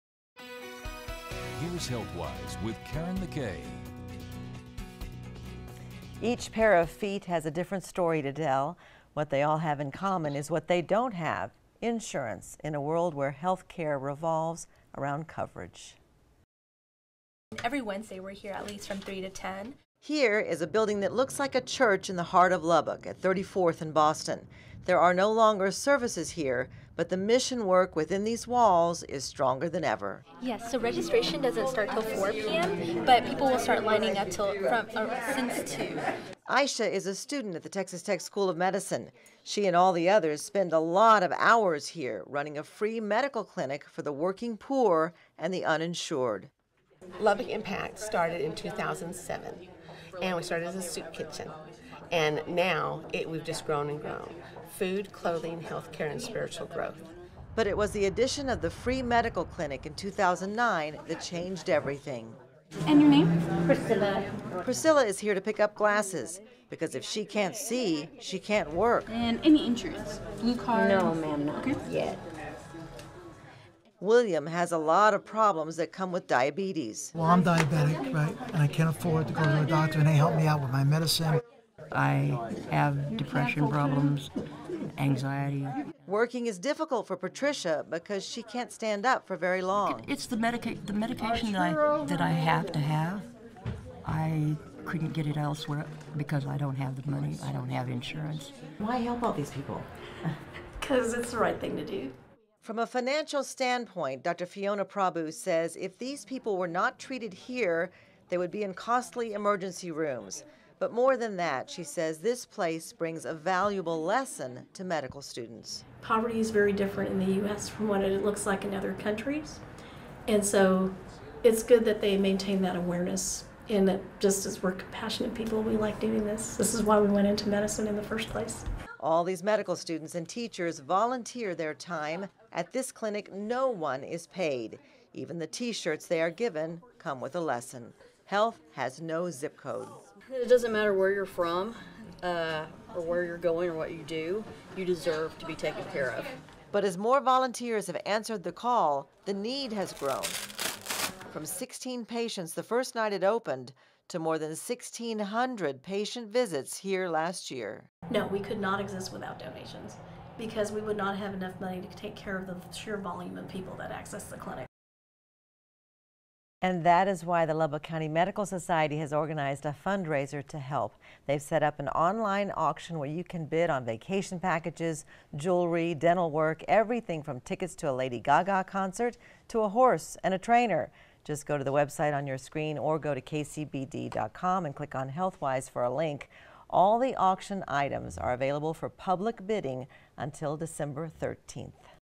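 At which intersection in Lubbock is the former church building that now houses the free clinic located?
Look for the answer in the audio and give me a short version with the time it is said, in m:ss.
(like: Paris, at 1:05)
34th and Boston, at 0:23.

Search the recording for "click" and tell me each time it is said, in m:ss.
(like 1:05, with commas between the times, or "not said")
3:04.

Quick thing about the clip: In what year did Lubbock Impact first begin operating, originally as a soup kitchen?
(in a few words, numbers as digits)
2007.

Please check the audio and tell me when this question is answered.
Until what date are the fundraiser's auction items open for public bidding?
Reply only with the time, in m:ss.
3:10.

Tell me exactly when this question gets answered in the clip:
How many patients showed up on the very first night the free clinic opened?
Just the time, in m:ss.
2:31.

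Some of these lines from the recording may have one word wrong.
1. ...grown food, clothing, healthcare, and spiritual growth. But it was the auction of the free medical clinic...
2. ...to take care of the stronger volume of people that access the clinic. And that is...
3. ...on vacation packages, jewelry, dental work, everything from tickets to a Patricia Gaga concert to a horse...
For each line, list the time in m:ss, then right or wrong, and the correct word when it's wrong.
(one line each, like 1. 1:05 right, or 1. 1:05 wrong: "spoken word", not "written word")
1. 0:54 wrong: "addition", not "auction"
2. 2:41 wrong: "sheer", not "stronger"
3. 2:53 wrong: "Lady", not "Patricia".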